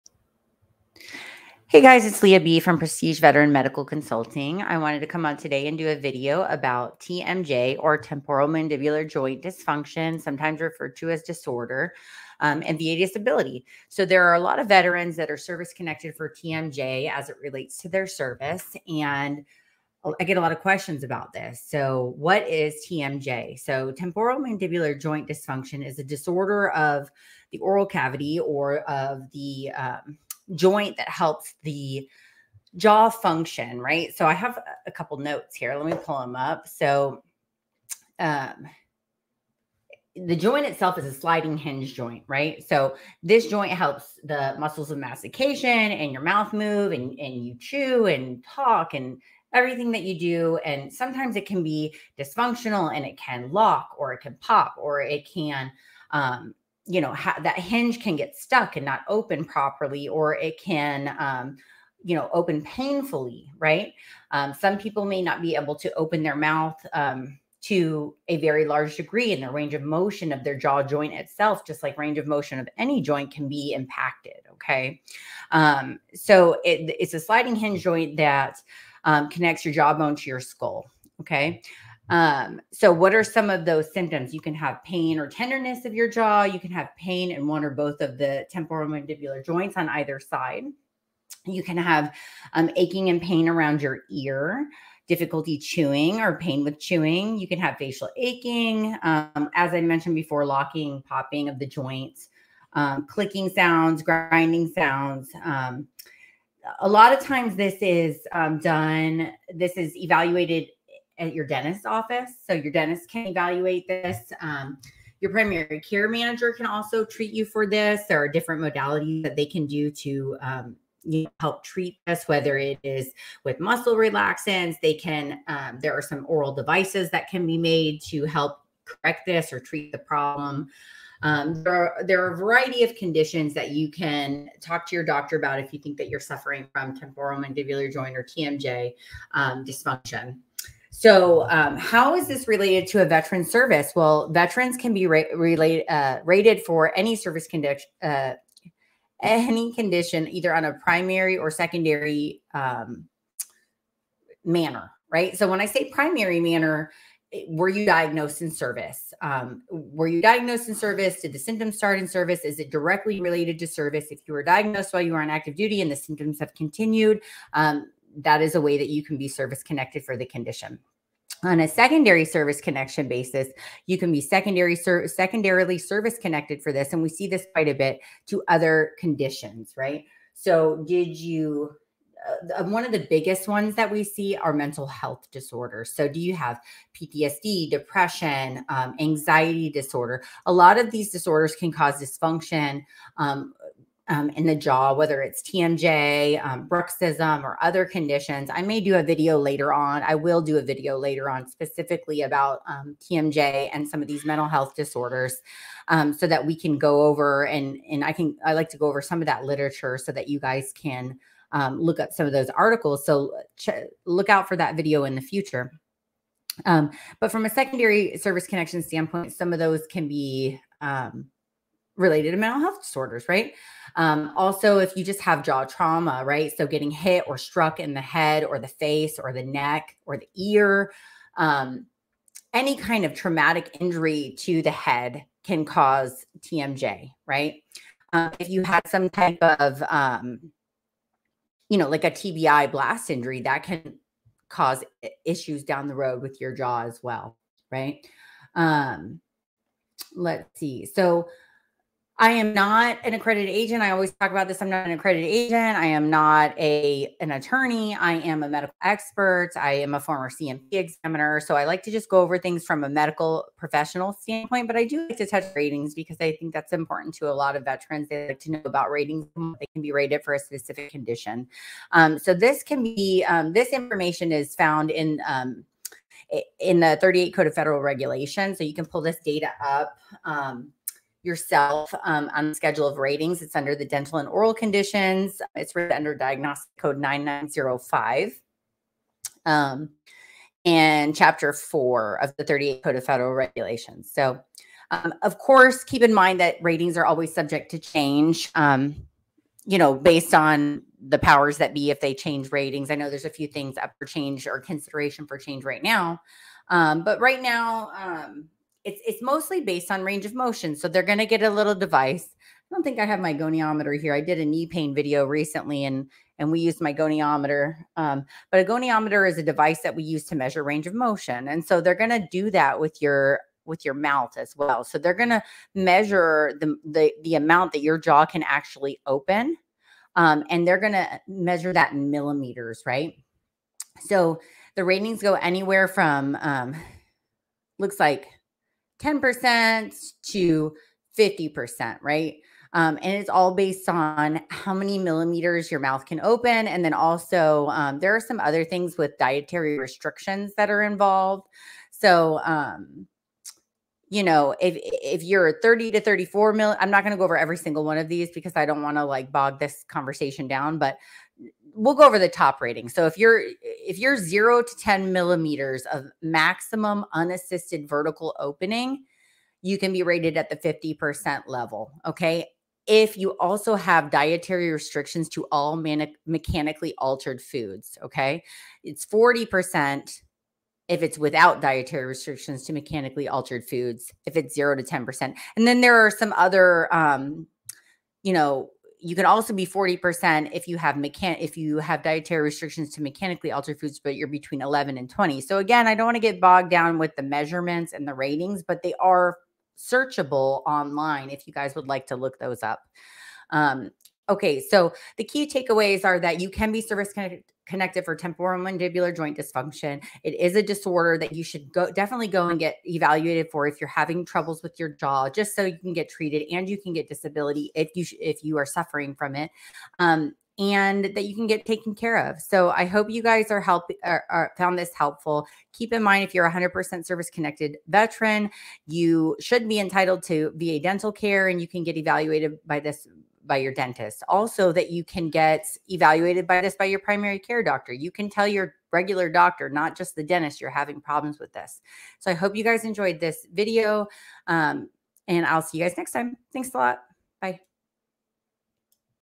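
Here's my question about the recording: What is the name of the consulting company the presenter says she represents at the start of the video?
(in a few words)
Prestige Veteran Medical Consulting.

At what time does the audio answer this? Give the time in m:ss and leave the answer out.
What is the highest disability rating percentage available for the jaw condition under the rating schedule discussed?
6:10.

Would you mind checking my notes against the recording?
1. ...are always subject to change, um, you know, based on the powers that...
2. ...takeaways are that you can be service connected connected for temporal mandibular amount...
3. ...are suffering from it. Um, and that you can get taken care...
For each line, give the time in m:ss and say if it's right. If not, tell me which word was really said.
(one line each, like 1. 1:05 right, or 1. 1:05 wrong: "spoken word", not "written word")
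1. 4:56 right
2. 6:45 wrong: "joint", not "amount"
3. 6:58 right.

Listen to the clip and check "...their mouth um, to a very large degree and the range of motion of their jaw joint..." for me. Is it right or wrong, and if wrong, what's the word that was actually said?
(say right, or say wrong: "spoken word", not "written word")
right.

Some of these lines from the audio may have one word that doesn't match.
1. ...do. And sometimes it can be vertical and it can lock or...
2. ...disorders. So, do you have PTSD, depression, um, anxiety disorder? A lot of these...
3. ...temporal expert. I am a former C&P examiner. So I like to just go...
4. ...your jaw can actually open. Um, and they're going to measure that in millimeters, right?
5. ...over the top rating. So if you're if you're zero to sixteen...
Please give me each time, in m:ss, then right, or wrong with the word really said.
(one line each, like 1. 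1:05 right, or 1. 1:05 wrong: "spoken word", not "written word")
1. 0:50 wrong: "dysfunctional", not "vertical"
2. 3:05 right
3. 4:18 wrong: "medical", not "temporal"
4. 5:27 right
5. 6:02 wrong: "ten", not "sixteen".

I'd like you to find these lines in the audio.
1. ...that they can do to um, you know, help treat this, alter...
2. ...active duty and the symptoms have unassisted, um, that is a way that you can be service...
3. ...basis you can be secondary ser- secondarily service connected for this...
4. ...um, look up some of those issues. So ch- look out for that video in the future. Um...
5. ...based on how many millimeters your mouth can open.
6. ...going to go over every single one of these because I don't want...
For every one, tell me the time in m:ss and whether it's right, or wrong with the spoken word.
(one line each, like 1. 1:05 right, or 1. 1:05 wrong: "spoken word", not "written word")
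1. 1:59 wrong: "whether", not "alter"
2. 2:45 wrong: "continued", not "unassisted"
3. 2:53 right
4. 3:31 wrong: "articles", not "issues"
5. 5:43 right
6. 5:57 right.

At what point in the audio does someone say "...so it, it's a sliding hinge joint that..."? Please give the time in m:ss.
1:16.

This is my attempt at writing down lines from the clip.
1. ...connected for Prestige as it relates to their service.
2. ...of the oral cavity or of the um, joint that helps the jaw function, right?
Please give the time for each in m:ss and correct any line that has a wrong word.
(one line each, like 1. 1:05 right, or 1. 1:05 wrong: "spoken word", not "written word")
1. 0:15 wrong: "TMJ", not "Prestige"
2. 0:26 right.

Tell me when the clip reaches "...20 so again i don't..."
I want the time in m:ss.
6:35.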